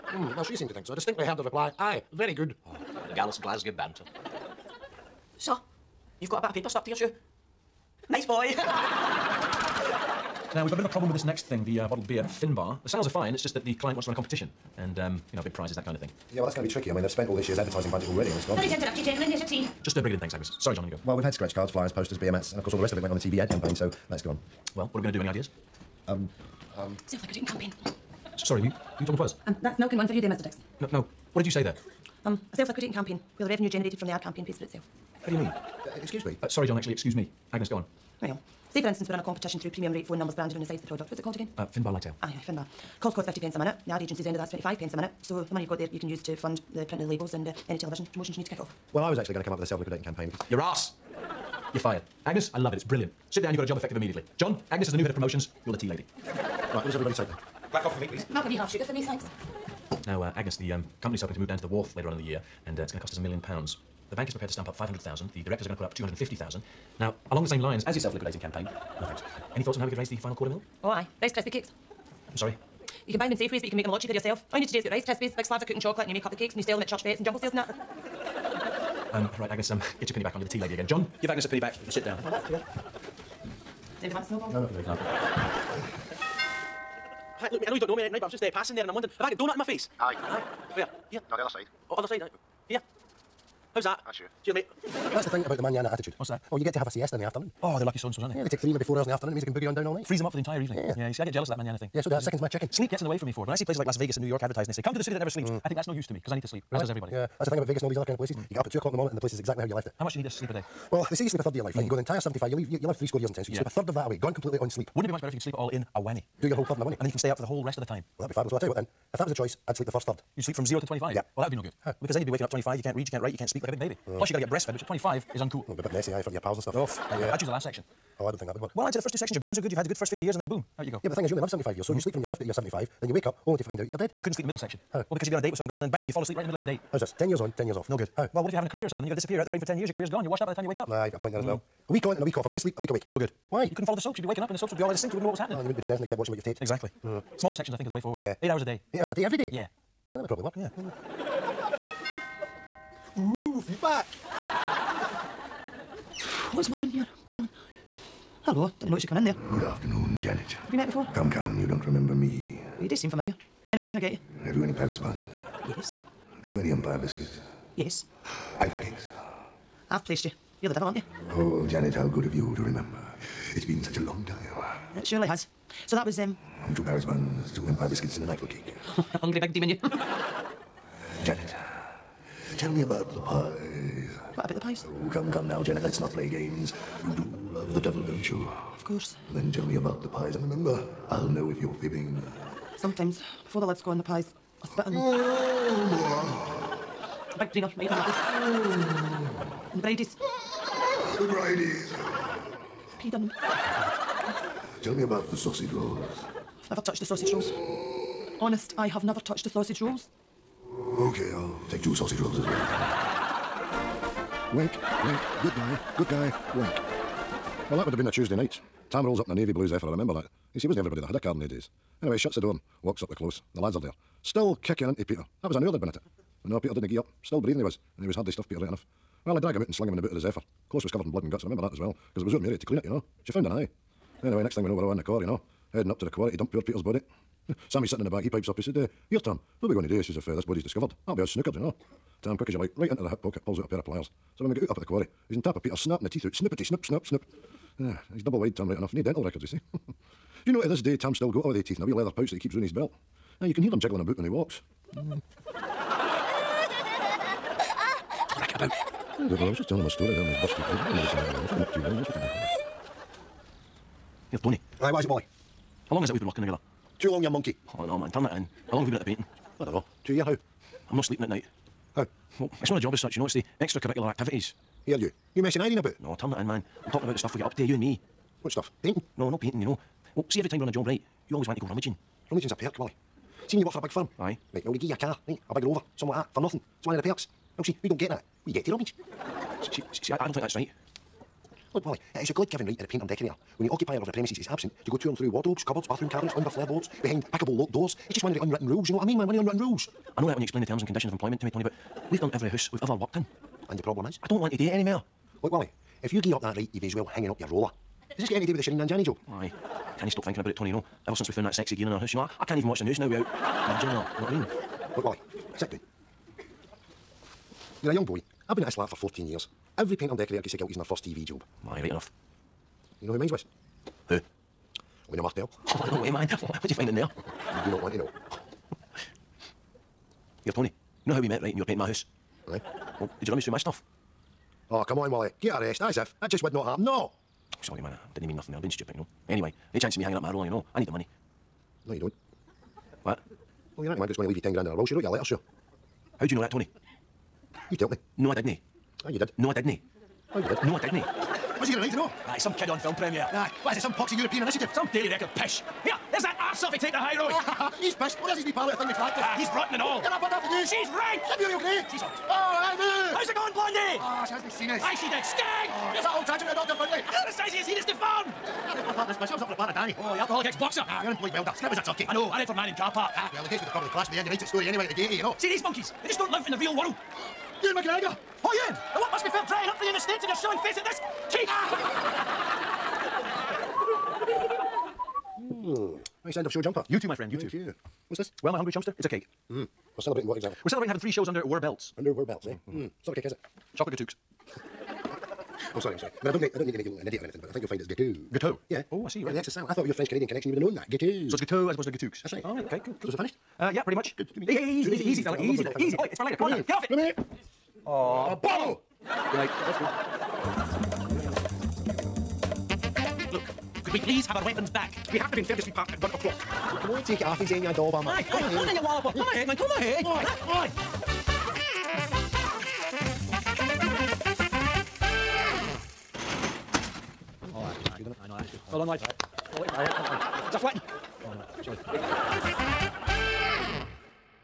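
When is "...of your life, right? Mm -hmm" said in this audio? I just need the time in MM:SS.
01:51.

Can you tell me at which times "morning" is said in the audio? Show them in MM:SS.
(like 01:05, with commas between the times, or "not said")
01:48.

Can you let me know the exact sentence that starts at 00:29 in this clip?
Um, that's milk and one for you there, Mr Dixon.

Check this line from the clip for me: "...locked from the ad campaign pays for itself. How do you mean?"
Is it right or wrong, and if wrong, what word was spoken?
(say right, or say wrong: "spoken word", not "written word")
wrong: "generated", not "locked".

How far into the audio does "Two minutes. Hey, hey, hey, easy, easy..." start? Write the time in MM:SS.
06:44.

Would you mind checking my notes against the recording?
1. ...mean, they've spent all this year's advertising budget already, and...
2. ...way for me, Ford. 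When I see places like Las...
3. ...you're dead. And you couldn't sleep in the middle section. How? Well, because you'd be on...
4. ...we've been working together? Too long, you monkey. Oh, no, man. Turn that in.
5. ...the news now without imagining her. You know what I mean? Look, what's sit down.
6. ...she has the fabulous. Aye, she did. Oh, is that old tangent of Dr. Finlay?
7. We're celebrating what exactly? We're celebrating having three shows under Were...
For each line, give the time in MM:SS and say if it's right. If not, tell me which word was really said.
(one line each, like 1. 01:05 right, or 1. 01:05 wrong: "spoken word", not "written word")
1. 00:16 right
2. 01:43 right
3. 02:13 right
4. 04:26 right
5. 05:12 right
6. 06:04 wrong: "sinus", not "fabulous"
7. 06:29 right.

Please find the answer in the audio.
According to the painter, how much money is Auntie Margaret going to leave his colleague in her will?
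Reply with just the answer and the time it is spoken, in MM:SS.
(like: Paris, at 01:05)
ten grand, at 05:44.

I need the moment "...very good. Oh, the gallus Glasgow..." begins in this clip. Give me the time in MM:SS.
00:02.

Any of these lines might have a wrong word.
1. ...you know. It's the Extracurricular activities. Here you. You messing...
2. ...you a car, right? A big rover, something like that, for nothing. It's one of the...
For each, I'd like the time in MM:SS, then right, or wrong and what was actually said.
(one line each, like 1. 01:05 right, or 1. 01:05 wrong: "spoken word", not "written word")
1. 04:33 right
2. 04:44 right.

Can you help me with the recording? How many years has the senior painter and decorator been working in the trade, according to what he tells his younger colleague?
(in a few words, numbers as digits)
14.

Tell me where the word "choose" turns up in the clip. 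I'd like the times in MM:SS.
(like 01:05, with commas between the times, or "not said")
02:07.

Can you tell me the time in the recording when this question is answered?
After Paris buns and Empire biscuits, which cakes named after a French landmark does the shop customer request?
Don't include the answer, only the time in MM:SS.
02:48.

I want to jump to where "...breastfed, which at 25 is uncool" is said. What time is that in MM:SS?
02:04.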